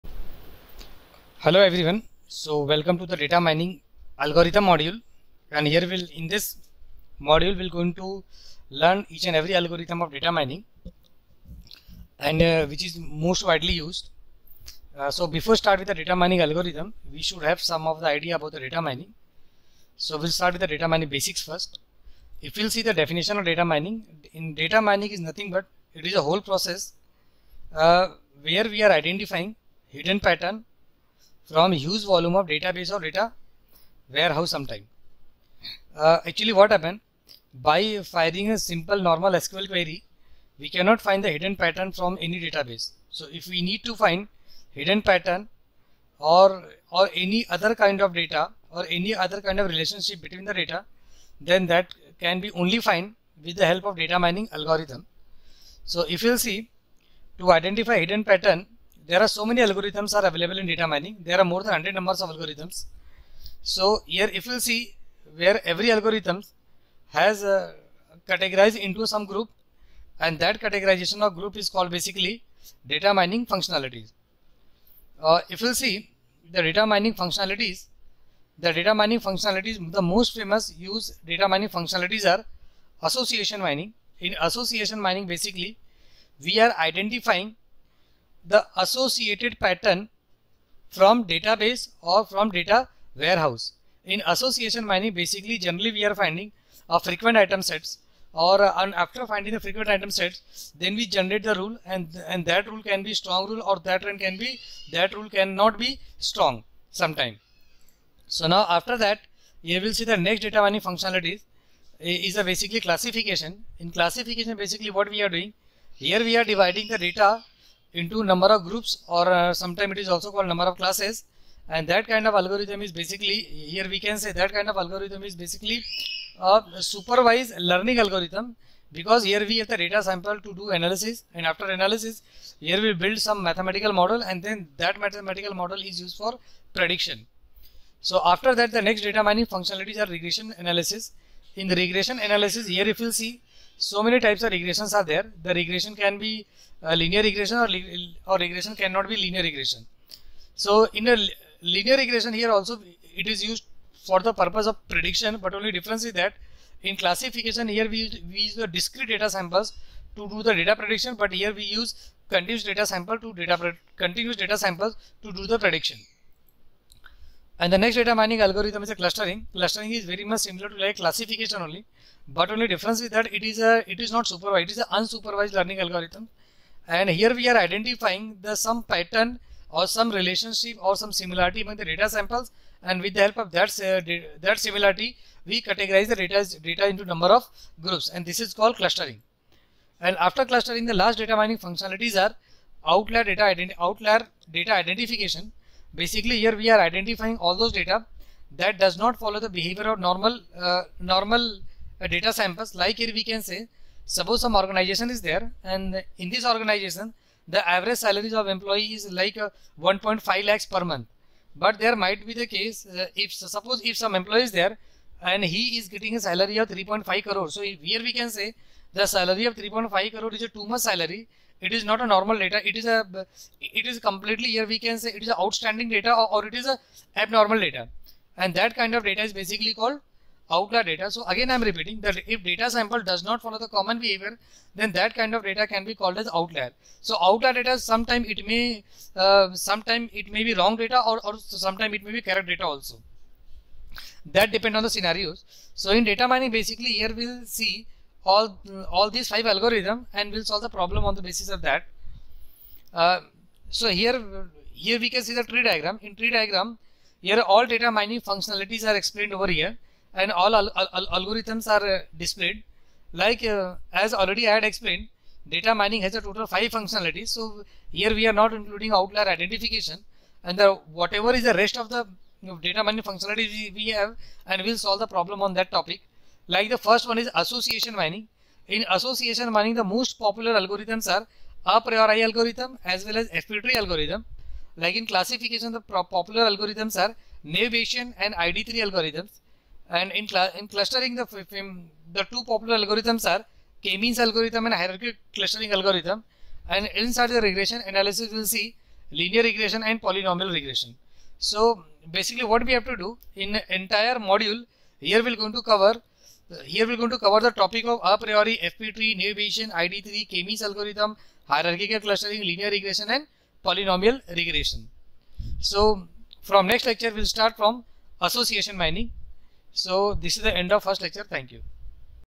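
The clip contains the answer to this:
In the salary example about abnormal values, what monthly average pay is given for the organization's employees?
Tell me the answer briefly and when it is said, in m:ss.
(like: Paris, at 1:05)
1.5 lakhs, at 3:29.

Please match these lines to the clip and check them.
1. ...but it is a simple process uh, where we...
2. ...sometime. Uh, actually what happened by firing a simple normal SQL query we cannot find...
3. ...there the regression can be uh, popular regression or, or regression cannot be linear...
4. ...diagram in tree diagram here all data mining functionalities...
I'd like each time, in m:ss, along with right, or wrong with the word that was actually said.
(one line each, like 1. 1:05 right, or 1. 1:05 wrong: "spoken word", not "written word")
1. 0:25 wrong: "whole", not "simple"
2. 0:34 right
3. 2:25 wrong: "linear", not "popular"
4. 4:15 right.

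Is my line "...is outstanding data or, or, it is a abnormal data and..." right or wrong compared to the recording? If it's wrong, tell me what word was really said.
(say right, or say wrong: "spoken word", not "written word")
right.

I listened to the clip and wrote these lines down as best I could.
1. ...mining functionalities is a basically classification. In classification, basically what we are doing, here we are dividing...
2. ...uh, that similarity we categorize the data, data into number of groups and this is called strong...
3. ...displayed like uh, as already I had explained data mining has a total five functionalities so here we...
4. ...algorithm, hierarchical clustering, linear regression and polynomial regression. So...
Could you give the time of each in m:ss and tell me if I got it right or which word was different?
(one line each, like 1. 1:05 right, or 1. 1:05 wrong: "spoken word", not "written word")
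1. 1:50 right
2. 3:03 wrong: "clustering", not "strong"
3. 4:22 right
4. 5:10 right.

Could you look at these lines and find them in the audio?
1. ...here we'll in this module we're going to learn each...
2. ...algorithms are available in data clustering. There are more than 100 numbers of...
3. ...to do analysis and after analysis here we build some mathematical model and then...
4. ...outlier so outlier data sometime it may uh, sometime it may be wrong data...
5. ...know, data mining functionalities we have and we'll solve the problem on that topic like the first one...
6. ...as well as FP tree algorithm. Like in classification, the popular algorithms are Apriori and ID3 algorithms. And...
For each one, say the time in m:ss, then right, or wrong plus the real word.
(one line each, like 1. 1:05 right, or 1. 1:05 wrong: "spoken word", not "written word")
1. 0:05 right
2. 0:59 wrong: "mining", not "clustering"
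3. 2:10 right
4. 3:56 right
5. 4:32 right
6. 4:42 wrong: "Bayes", not "Apriori".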